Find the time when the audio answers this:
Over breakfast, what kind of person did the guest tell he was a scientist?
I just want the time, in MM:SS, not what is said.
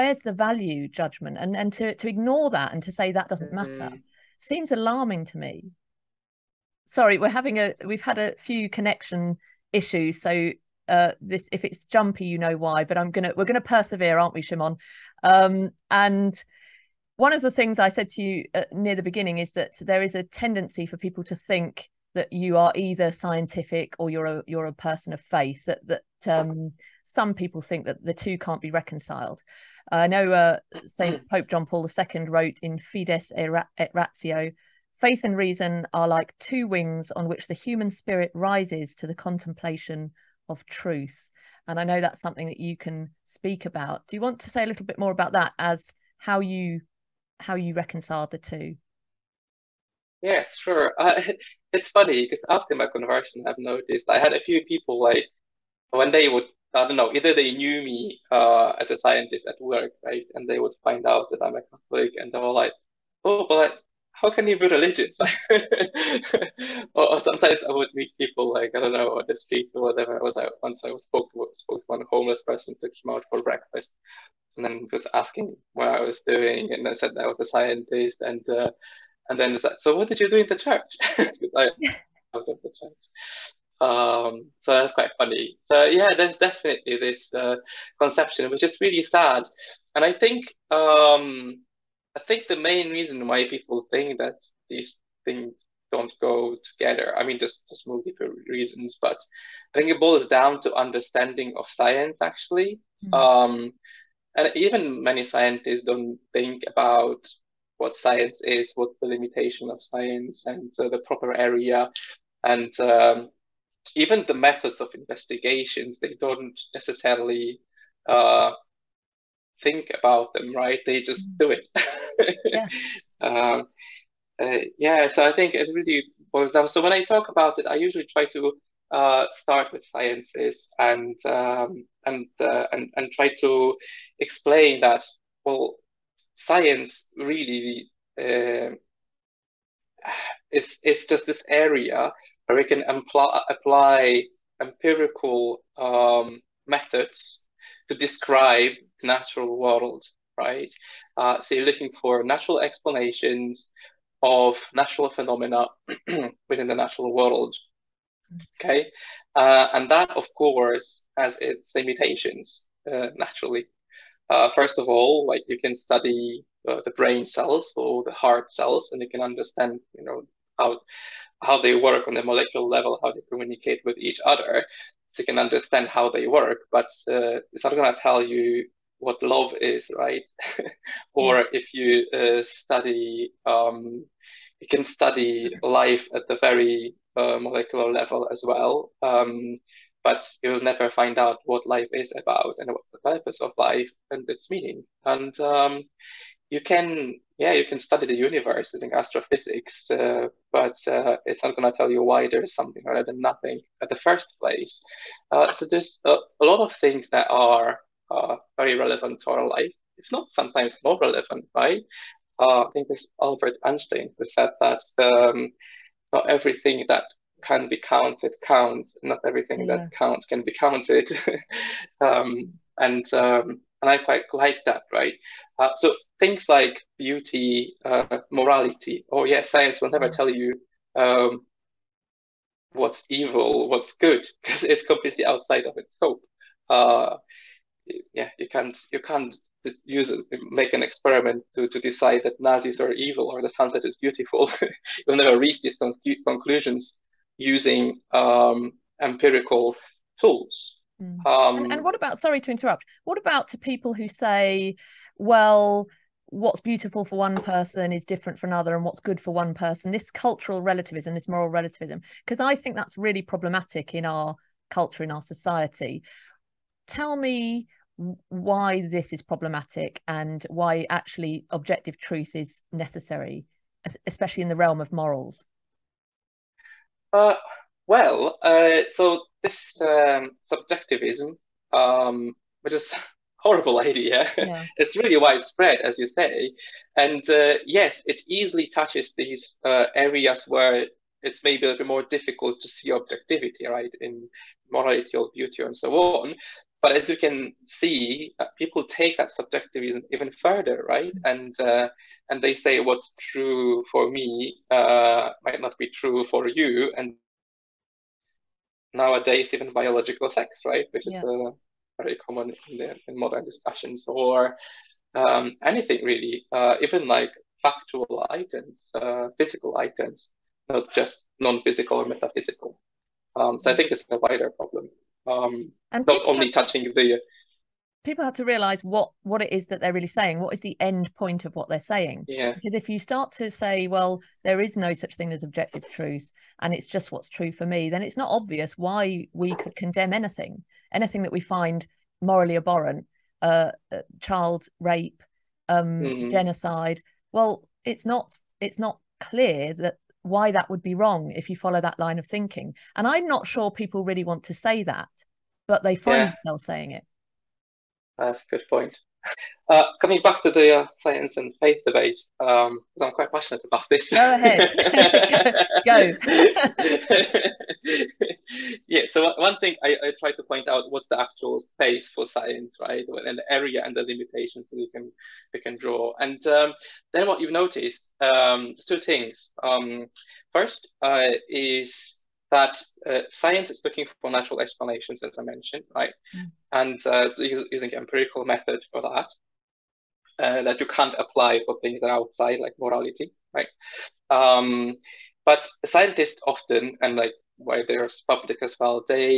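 01:12.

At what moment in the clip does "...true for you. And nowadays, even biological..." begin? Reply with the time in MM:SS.
05:05.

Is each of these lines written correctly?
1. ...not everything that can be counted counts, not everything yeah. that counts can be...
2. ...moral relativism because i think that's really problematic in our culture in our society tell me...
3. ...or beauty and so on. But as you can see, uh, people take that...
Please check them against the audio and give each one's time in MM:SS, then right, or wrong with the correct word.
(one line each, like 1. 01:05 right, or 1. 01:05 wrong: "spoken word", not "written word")
1. 03:36 right
2. 04:21 right
3. 04:55 right.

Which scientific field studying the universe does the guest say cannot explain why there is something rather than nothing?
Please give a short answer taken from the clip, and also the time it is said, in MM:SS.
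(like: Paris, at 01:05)
astrophysics, at 03:18.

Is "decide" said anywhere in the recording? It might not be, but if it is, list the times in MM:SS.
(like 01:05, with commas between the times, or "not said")
04:01.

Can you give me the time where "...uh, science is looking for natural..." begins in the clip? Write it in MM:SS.
06:23.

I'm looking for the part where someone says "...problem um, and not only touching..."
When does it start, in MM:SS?
05:24.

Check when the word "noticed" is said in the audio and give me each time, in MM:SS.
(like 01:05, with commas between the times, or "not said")
00:53, 06:17.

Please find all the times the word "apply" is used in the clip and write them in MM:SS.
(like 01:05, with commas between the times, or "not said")
02:23, 06:31.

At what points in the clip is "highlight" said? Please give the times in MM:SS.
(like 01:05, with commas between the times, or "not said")
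not said.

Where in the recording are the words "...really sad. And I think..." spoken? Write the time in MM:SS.
01:28.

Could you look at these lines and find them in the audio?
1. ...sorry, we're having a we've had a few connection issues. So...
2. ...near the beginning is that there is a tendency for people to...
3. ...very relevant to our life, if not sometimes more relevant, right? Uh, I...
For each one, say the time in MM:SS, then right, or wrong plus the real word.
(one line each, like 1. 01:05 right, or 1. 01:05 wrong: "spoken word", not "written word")
1. 00:06 right
2. 00:18 right
3. 03:28 right.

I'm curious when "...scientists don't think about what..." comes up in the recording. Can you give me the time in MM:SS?
01:45.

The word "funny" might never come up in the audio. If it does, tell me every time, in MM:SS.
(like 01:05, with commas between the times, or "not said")
00:51, 01:25.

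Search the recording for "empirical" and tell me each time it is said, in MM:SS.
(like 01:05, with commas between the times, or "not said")
02:24, 04:09, 06:27.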